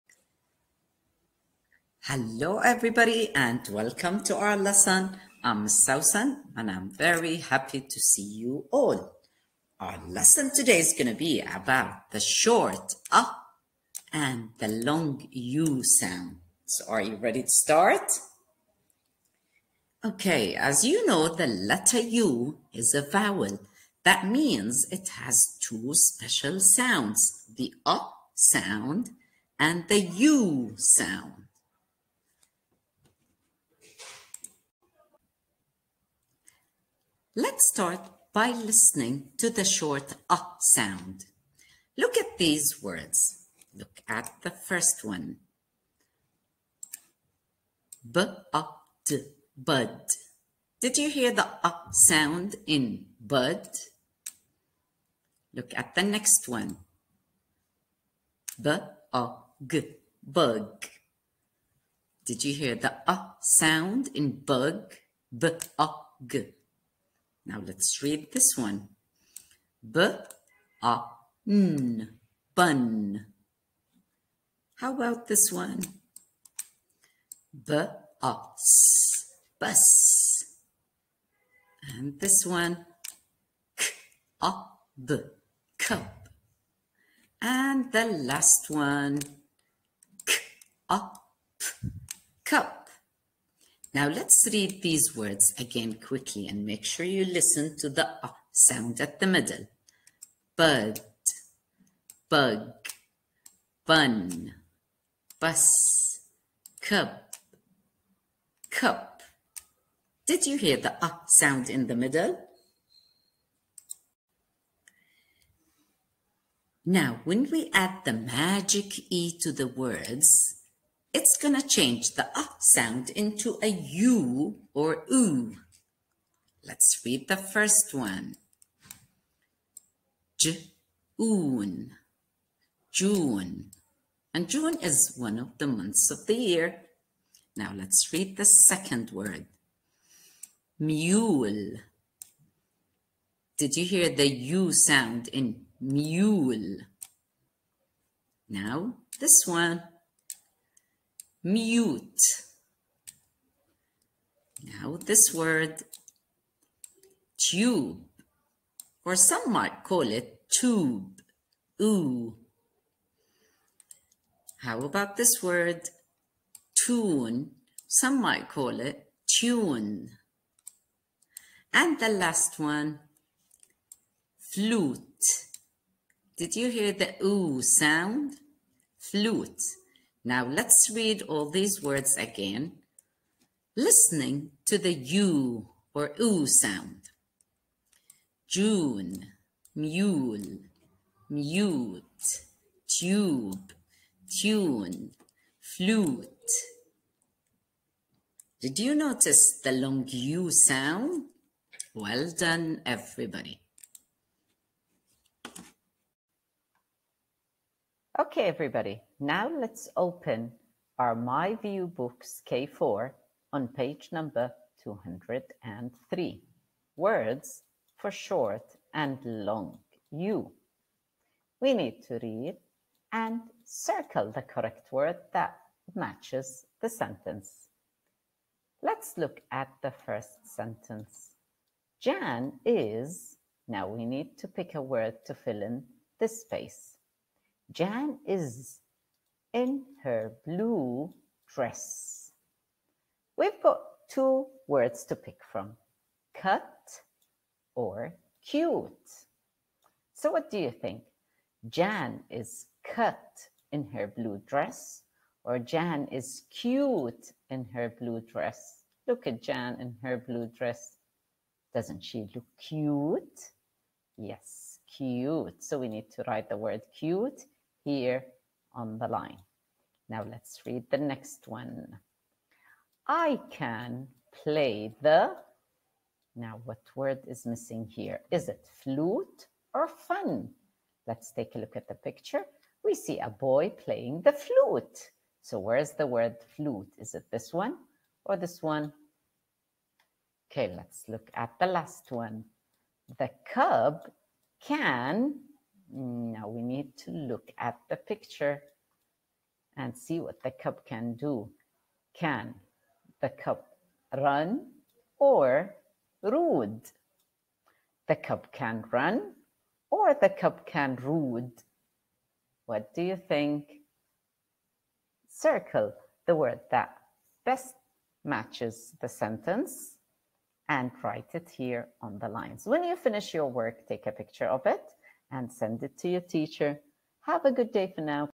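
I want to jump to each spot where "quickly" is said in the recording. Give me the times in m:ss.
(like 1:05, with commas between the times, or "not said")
1:35.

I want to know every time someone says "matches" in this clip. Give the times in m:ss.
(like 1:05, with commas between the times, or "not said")
3:45, 5:18.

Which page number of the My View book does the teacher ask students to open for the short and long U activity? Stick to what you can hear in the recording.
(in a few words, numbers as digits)
203.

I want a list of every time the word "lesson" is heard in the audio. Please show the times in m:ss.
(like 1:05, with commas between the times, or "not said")
0:04, 0:10.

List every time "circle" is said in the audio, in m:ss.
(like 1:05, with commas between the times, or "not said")
3:43, 5:15.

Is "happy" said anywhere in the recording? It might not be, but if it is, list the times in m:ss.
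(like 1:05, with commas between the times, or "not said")
0:07.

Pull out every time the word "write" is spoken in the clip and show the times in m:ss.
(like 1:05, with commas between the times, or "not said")
4:26, 5:21.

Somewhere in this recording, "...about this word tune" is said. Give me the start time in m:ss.
2:44.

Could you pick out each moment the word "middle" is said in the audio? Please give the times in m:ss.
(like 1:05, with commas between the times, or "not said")
1:39, 1:51.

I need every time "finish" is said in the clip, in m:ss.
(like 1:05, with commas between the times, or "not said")
5:22.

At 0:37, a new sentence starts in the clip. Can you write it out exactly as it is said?
Let's start by listening to the short uh sound.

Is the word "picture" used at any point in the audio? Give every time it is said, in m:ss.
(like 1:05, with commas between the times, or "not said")
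4:41, 4:57, 5:24.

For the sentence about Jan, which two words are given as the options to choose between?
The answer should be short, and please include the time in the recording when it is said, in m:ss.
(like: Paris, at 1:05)
cut or cute, at 4:06.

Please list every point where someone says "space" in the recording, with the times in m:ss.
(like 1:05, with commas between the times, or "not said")
3:56.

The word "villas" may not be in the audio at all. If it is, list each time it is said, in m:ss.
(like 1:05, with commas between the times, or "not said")
not said.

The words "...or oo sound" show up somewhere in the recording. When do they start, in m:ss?
3:05.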